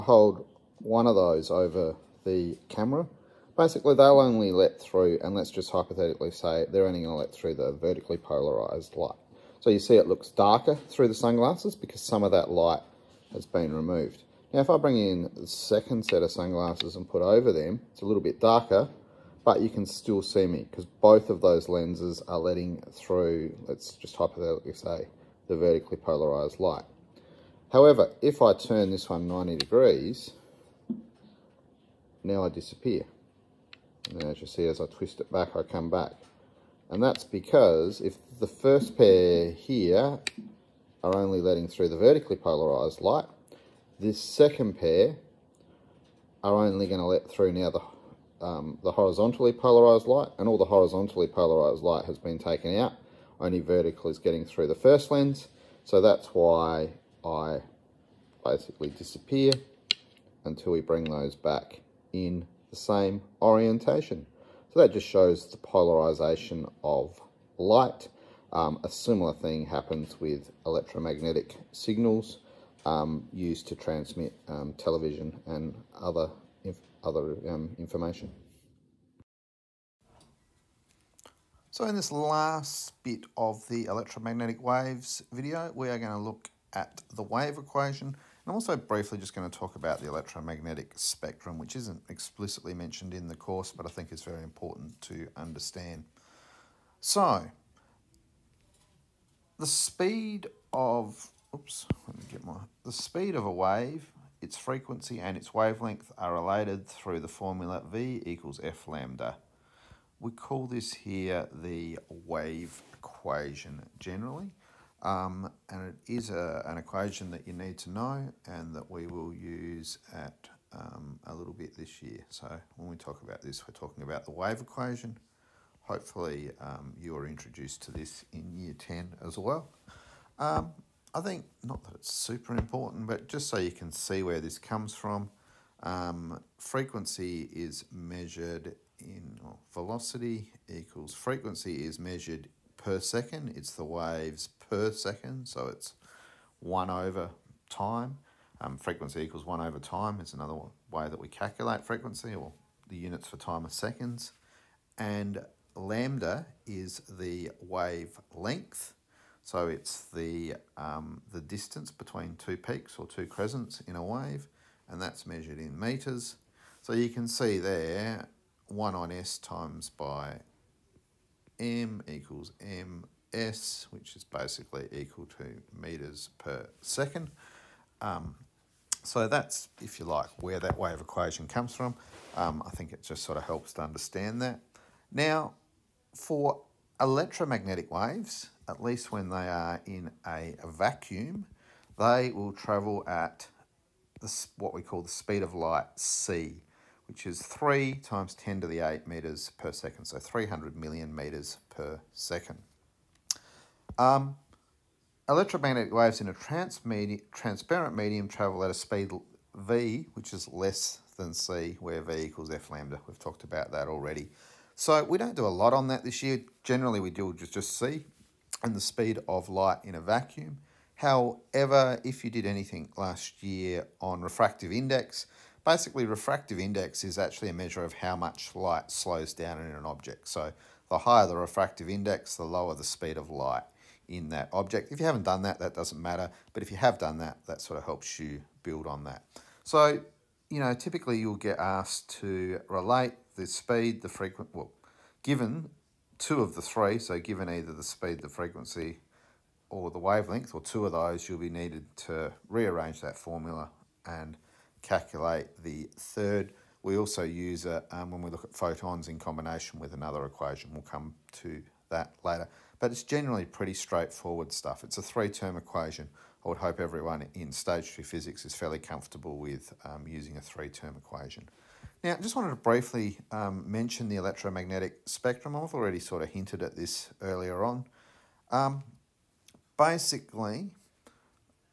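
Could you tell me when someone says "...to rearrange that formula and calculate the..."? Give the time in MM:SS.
04:11.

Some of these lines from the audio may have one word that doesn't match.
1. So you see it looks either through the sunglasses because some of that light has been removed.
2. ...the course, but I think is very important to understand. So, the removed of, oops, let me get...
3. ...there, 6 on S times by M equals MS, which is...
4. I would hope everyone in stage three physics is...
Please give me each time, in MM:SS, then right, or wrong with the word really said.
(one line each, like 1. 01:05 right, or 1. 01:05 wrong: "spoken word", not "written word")
1. 00:09 wrong: "darker", not "either"
2. 01:33 wrong: "speed", not "removed"
3. 02:47 wrong: "1", not "6"
4. 04:26 right.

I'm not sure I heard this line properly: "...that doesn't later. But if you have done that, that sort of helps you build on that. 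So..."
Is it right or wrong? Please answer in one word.
wrong.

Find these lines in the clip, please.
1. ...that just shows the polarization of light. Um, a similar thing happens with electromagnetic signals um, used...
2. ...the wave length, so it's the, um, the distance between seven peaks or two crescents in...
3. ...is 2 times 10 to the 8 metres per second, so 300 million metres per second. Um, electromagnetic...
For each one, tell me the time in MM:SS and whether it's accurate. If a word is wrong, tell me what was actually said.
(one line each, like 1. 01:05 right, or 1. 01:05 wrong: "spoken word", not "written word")
1. 01:04 right
2. 02:37 wrong: "two", not "seven"
3. 03:17 wrong: "3", not "2".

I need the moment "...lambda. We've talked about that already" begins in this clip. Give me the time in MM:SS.
03:32.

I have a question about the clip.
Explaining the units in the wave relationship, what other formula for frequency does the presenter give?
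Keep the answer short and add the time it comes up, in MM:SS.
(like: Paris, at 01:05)
1 over time, at 02:28.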